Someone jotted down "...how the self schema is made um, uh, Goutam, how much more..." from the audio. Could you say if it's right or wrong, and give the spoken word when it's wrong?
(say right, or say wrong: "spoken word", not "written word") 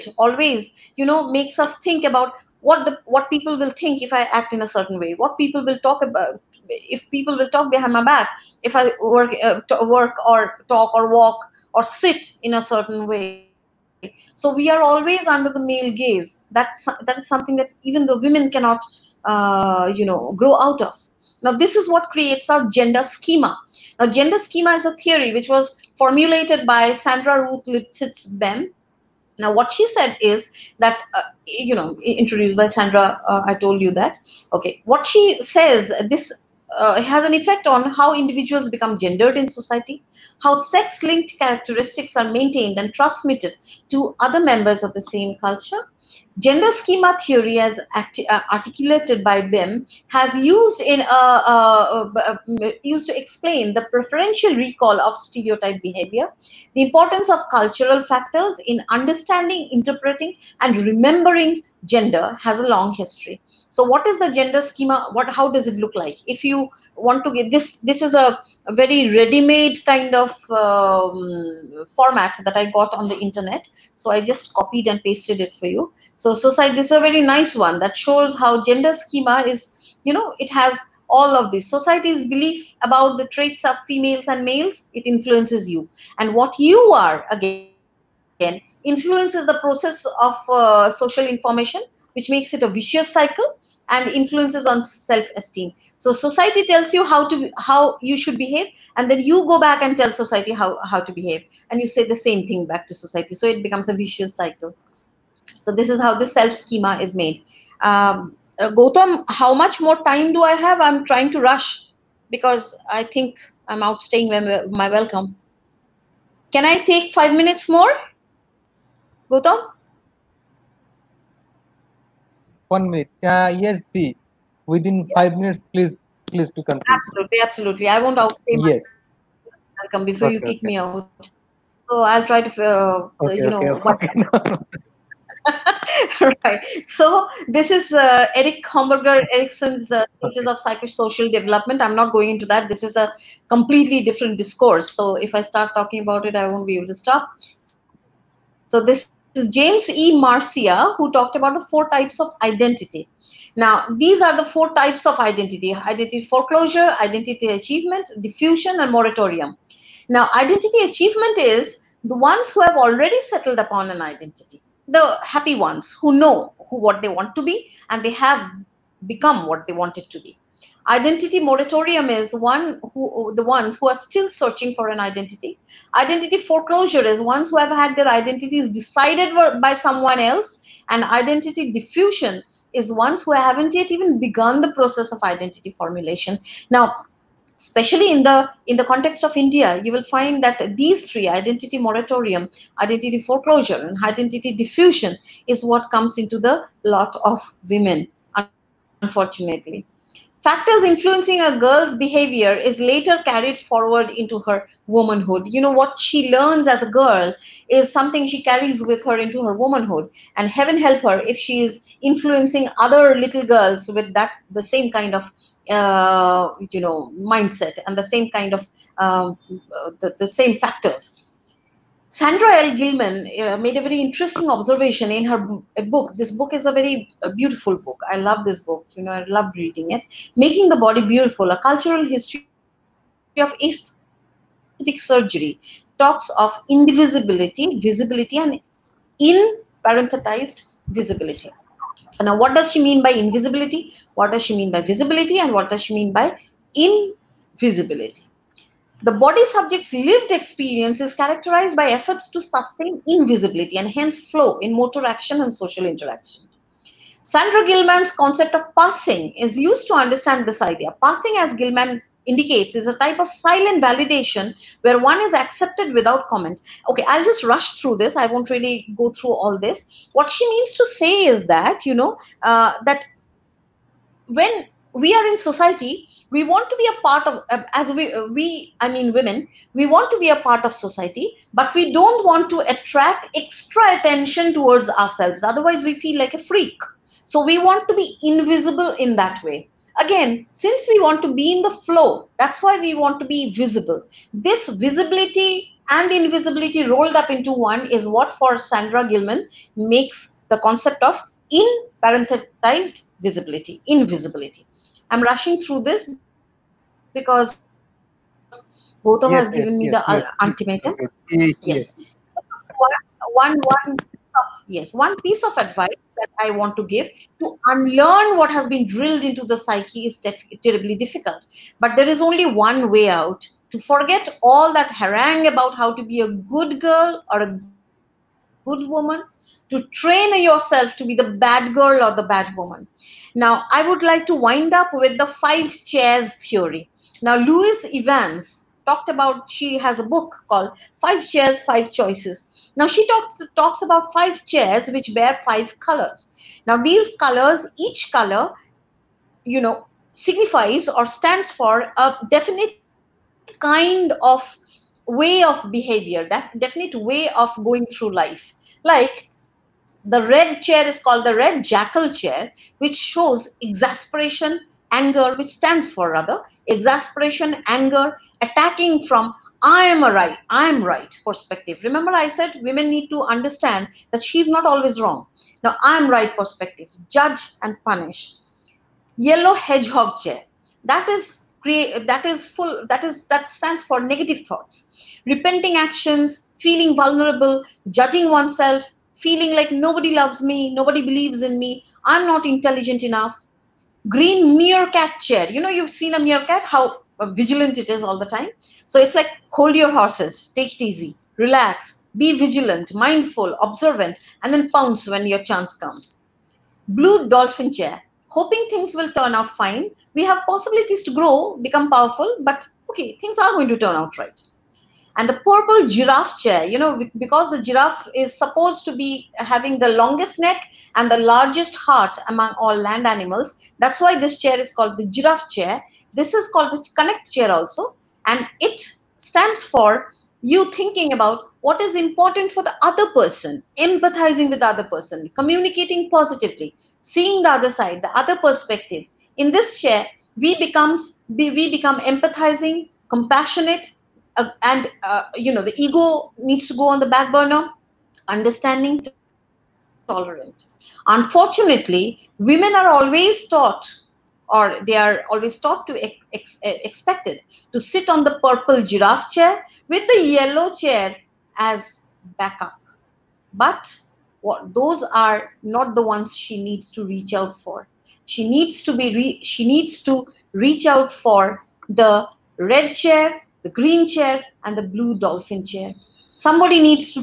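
right.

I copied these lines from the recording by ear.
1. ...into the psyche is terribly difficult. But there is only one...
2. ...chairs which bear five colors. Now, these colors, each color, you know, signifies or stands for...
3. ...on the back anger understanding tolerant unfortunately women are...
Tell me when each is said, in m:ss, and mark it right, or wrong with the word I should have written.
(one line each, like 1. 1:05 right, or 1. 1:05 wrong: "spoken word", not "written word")
1. 5:19 right
2. 5:44 right
3. 7:26 wrong: "burner", not "anger".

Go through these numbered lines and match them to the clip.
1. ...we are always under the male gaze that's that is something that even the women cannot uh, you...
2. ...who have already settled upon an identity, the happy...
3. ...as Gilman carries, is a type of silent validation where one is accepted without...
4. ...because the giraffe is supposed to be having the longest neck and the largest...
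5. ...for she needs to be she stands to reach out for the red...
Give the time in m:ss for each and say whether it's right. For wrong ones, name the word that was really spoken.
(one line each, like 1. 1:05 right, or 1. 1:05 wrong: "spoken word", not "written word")
1. 0:14 right
2. 2:42 right
3. 4:21 wrong: "indicates", not "carries"
4. 6:57 right
5. 7:47 wrong: "needs", not "stands".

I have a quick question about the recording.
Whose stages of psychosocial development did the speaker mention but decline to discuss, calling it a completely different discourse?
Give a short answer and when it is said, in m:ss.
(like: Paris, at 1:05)
Erik Homburger Erikson, at 2:18.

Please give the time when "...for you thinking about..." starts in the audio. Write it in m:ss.
7:09.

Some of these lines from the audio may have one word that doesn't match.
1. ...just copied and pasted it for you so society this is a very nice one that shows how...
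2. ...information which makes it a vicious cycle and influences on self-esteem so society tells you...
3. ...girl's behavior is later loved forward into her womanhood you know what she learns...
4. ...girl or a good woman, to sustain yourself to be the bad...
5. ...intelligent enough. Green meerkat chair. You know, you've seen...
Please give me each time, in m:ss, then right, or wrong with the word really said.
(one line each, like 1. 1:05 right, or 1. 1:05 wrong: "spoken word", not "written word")
1. 1:14 right
2. 1:31 right
3. 3:21 wrong: "carried", not "loved"
4. 5:26 wrong: "train", not "sustain"
5. 6:32 right.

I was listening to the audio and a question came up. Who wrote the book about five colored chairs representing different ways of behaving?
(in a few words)
Louise Evans.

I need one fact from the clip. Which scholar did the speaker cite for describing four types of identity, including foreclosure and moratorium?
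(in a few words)
James E. Marcia.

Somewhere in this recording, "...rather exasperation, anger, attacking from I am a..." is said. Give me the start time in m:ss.
6:06.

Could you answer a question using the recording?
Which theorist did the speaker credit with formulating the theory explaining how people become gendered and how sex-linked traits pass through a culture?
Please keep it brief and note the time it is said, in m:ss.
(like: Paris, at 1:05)
Sandra Ruth Lipsitz Bem, at 0:26.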